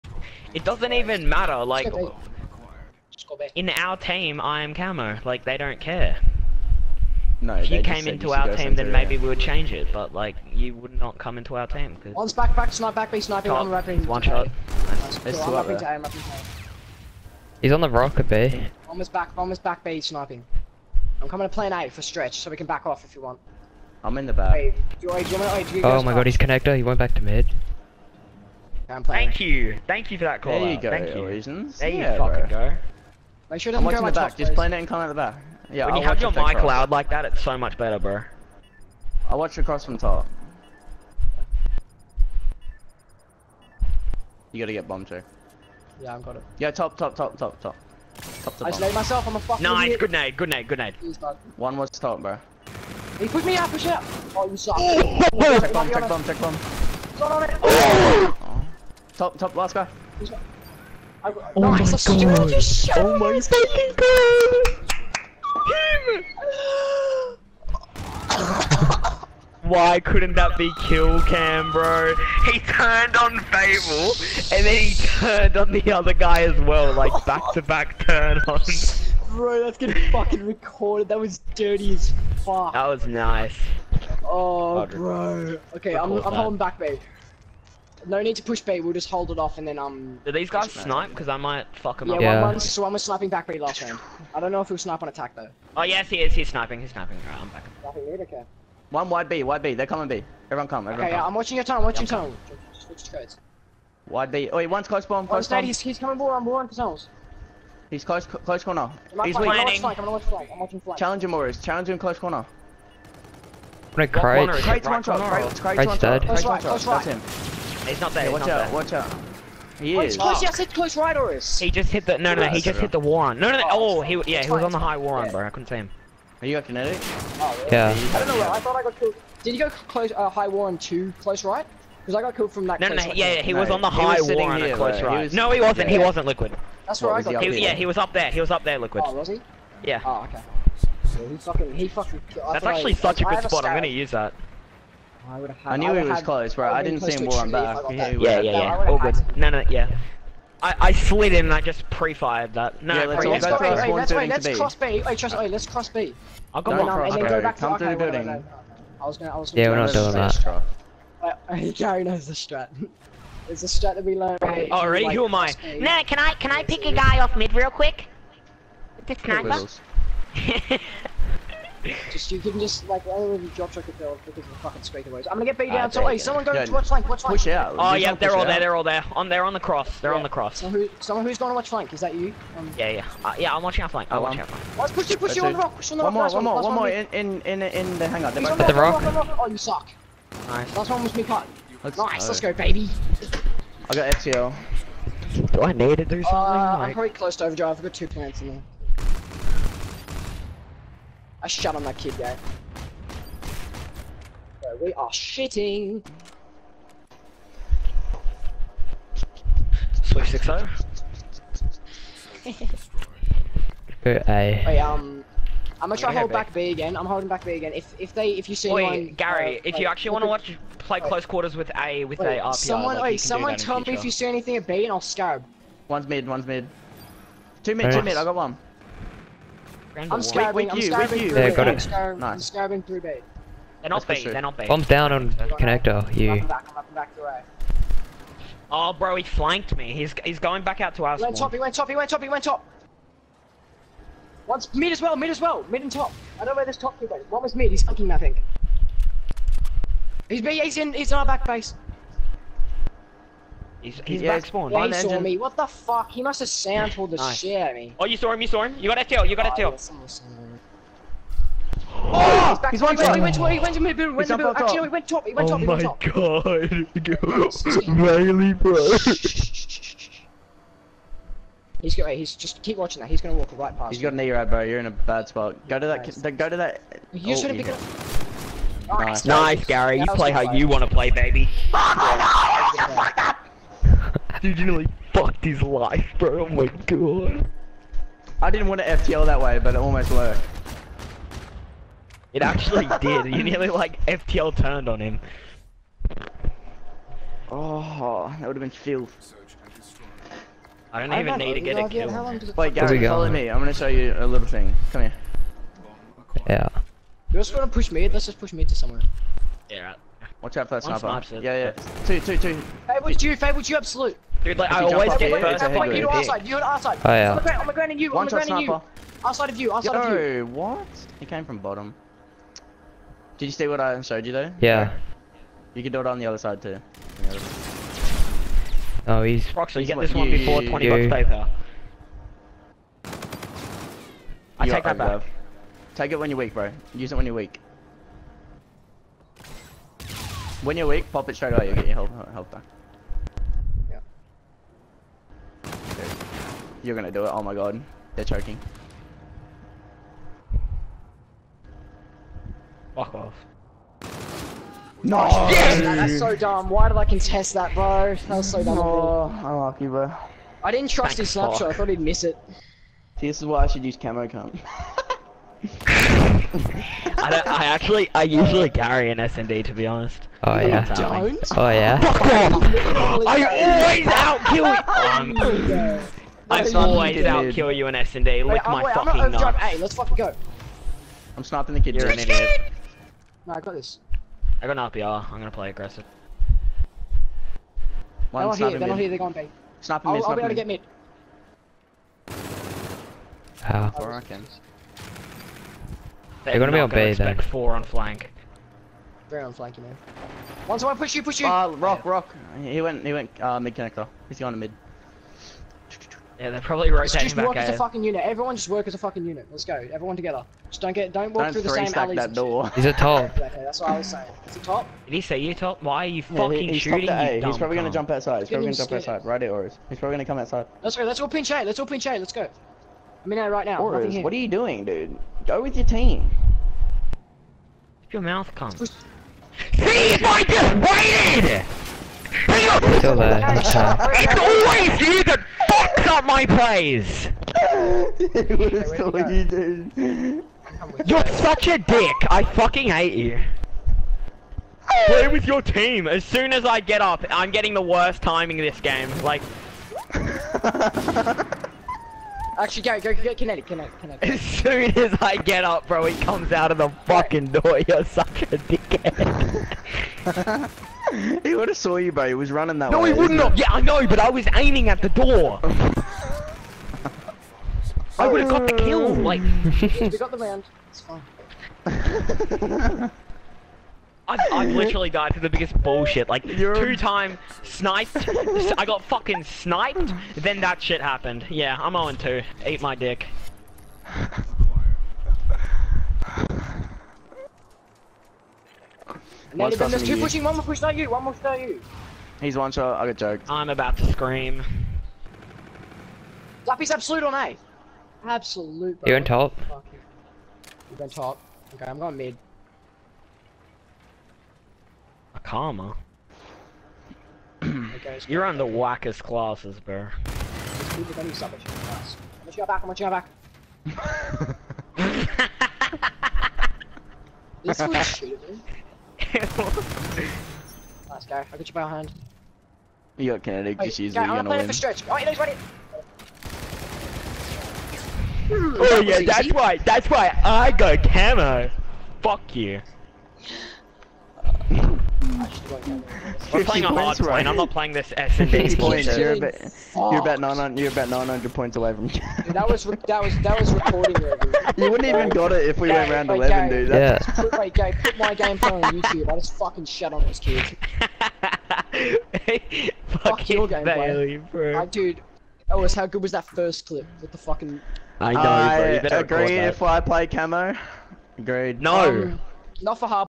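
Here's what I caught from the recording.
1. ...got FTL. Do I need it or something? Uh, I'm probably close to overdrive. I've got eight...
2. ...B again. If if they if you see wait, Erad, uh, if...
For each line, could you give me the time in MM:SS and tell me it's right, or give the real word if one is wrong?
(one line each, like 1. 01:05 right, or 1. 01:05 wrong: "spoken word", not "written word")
1. 03:13 wrong: "two", not "eight"
2. 03:37 wrong: "Gary", not "Erad".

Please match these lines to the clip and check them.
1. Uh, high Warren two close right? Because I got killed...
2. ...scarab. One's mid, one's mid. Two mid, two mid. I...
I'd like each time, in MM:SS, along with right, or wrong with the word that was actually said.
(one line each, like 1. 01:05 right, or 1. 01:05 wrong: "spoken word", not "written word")
1. 02:10 right
2. 03:45 right.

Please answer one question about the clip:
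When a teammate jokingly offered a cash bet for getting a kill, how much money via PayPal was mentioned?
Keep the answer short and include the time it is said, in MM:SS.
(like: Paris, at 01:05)
20 bucks, at 05:30.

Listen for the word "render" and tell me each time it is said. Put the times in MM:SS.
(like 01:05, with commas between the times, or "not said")
not said.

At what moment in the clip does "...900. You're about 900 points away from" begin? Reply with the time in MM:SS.
09:00.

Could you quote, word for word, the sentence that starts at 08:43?
You got kinetic, just use it, you're gonna win.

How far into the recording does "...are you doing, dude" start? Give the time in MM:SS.
07:04.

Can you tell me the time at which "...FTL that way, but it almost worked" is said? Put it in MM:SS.
04:48.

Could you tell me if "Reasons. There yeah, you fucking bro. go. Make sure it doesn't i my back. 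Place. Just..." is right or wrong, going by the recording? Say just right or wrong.
right.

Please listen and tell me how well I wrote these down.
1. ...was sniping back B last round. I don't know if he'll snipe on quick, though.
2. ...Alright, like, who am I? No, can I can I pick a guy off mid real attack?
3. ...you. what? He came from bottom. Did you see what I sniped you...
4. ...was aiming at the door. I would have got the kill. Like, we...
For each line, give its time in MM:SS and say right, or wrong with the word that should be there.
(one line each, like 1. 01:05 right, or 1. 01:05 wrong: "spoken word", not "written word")
1. 01:32 wrong: "attack", not "quick"
2. 02:44 wrong: "quick", not "attack"
3. 05:20 wrong: "showed", not "sniped"
4. 07:44 right.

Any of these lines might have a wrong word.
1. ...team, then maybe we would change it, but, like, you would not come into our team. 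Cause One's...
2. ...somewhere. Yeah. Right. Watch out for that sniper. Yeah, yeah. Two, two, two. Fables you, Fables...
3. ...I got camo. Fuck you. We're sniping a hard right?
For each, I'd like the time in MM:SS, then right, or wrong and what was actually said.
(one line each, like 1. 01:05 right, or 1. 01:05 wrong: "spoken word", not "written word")
1. 00:08 right
2. 05:08 right
3. 08:50 wrong: "playing", not "sniping".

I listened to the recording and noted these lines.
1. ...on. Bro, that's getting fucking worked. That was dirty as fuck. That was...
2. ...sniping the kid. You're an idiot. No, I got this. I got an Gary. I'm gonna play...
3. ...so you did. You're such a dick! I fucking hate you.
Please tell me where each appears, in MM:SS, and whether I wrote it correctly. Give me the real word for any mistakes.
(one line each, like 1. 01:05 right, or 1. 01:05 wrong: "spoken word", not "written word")
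1. 01:18 wrong: "recorded", not "worked"
2. 06:21 wrong: "RPR", not "Gary"
3. 07:18 right.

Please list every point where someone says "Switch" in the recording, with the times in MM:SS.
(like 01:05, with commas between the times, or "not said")
01:42, 03:30.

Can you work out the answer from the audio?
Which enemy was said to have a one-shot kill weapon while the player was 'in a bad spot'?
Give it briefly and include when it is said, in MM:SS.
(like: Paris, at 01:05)
E-rad, at 04:34.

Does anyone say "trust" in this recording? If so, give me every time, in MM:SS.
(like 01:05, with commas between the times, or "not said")
02:35, 06:00.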